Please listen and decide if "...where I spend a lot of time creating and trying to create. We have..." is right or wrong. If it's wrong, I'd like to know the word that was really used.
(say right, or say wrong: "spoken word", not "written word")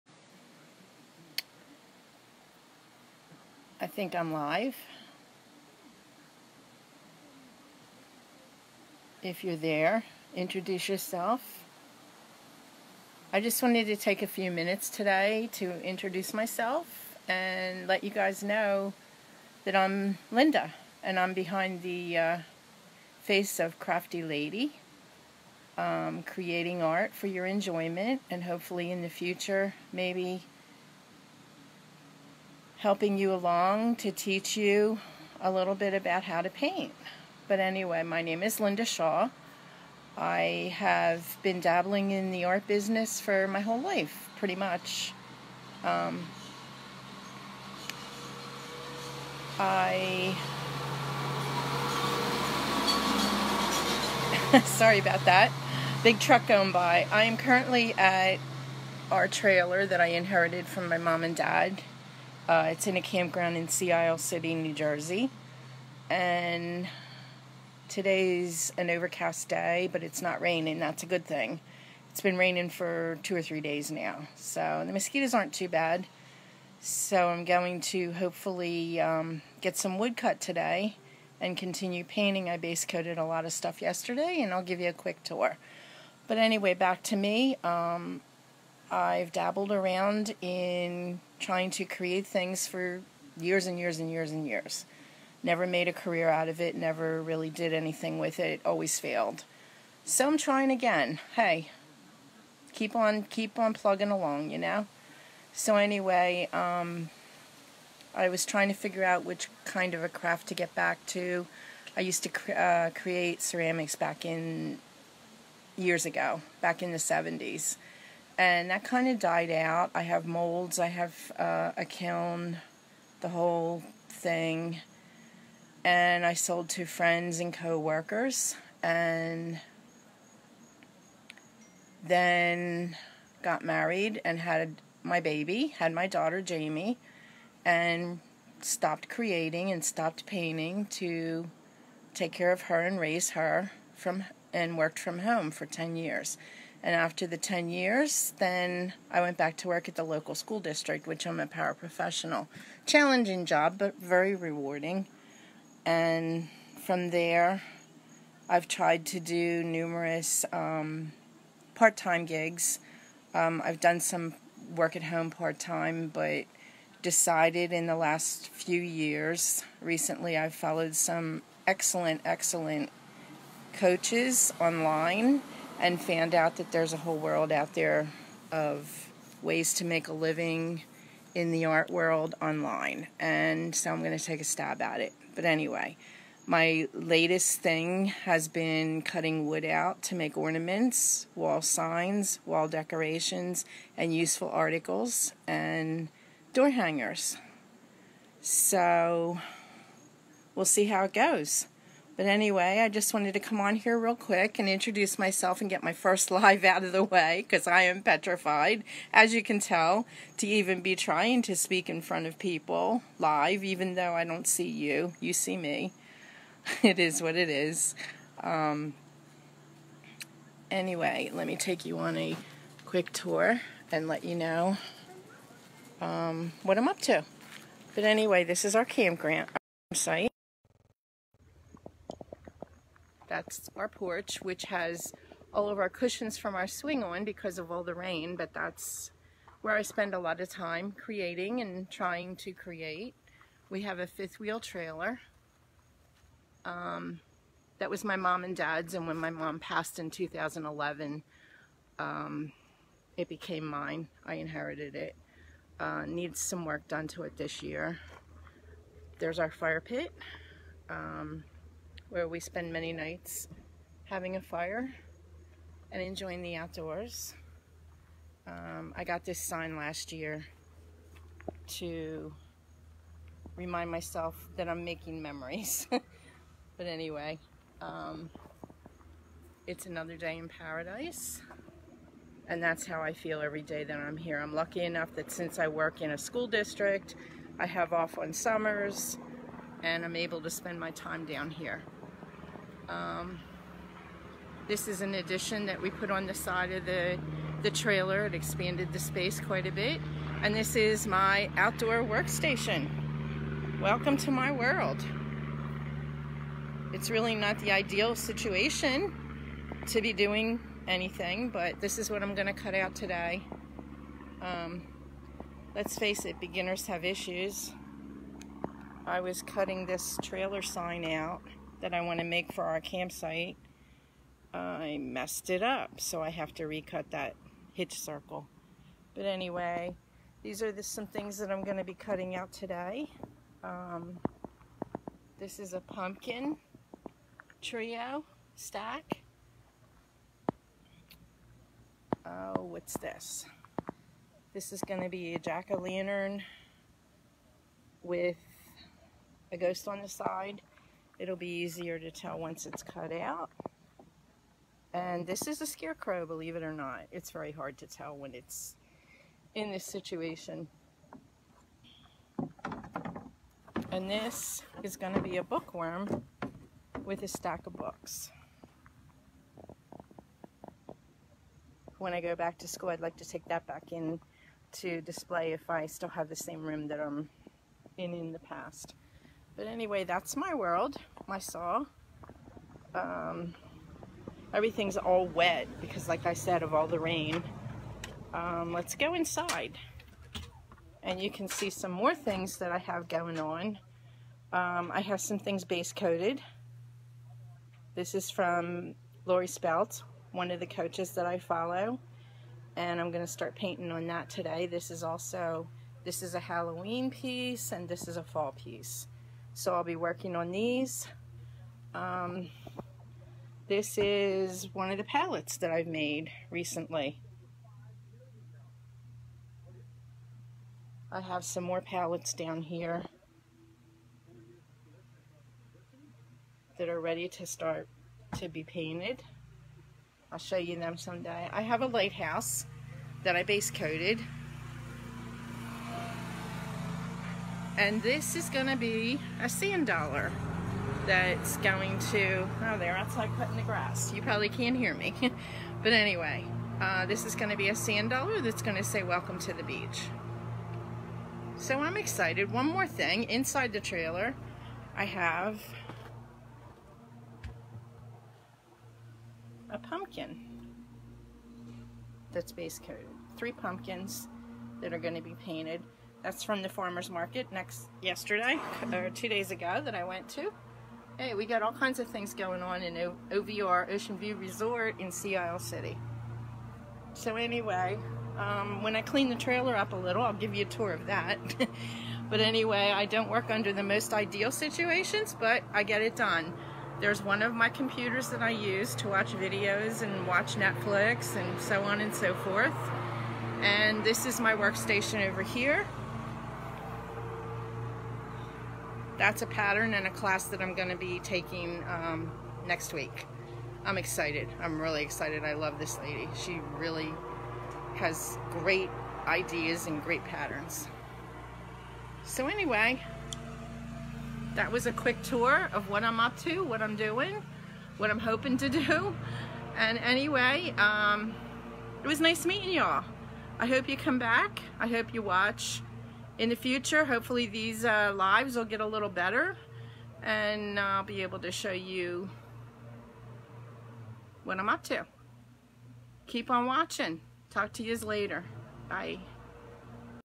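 right.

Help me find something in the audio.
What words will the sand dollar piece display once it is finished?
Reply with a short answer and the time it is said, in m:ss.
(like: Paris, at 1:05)
Welcome to the beach, at 7:29.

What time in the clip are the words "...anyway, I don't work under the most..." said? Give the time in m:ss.
8:02.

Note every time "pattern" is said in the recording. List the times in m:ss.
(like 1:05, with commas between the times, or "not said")
8:19, 8:30.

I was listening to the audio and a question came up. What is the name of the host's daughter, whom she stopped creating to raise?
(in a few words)
Jamie.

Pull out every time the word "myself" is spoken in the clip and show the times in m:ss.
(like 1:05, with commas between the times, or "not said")
0:16, 3:25, 4:33.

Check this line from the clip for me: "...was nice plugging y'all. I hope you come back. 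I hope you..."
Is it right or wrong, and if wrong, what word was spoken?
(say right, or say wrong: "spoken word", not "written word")
wrong: "meeting", not "plugging".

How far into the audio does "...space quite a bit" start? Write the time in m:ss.
4:58.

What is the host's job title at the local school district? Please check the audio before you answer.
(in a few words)
Paraprofessional.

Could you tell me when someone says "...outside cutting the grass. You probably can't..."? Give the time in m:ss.
7:22.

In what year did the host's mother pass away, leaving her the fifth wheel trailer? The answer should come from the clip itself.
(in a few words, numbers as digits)
2011.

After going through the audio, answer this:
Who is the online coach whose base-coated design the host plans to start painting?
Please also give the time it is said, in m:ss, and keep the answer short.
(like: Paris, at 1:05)
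Lori Spelt, at 6:39.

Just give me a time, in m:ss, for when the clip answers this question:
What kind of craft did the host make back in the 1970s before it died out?
1:53.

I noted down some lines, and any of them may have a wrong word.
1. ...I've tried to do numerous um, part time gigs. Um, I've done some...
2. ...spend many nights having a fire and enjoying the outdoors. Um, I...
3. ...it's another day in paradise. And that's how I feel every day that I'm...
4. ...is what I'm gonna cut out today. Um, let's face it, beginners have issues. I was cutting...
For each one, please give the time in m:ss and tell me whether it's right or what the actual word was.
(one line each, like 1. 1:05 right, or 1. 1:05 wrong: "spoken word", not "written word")
1. 2:38 right
2. 4:22 right
3. 4:39 right
4. 5:11 right.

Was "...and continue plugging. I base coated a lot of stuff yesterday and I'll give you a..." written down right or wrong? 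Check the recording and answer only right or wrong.
wrong.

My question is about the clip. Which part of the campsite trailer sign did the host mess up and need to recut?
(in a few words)
Hitch circle.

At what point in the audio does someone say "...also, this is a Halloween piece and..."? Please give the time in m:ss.
6:45.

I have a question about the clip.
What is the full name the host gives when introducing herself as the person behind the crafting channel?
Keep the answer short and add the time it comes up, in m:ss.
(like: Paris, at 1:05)
Linda Shaw, at 0:38.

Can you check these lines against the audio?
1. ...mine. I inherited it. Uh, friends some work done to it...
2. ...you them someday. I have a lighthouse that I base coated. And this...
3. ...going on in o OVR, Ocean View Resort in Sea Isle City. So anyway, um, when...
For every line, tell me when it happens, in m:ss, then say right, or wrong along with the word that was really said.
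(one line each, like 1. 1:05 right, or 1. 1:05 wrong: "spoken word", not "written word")
1. 4:13 wrong: "needs", not "friends"
2. 7:10 right
3. 7:52 right.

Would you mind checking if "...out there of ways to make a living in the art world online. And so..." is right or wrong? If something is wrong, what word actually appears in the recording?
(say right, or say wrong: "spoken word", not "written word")
right.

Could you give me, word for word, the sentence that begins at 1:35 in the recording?
Never made a career out of it, never really did anything with it, it always failed.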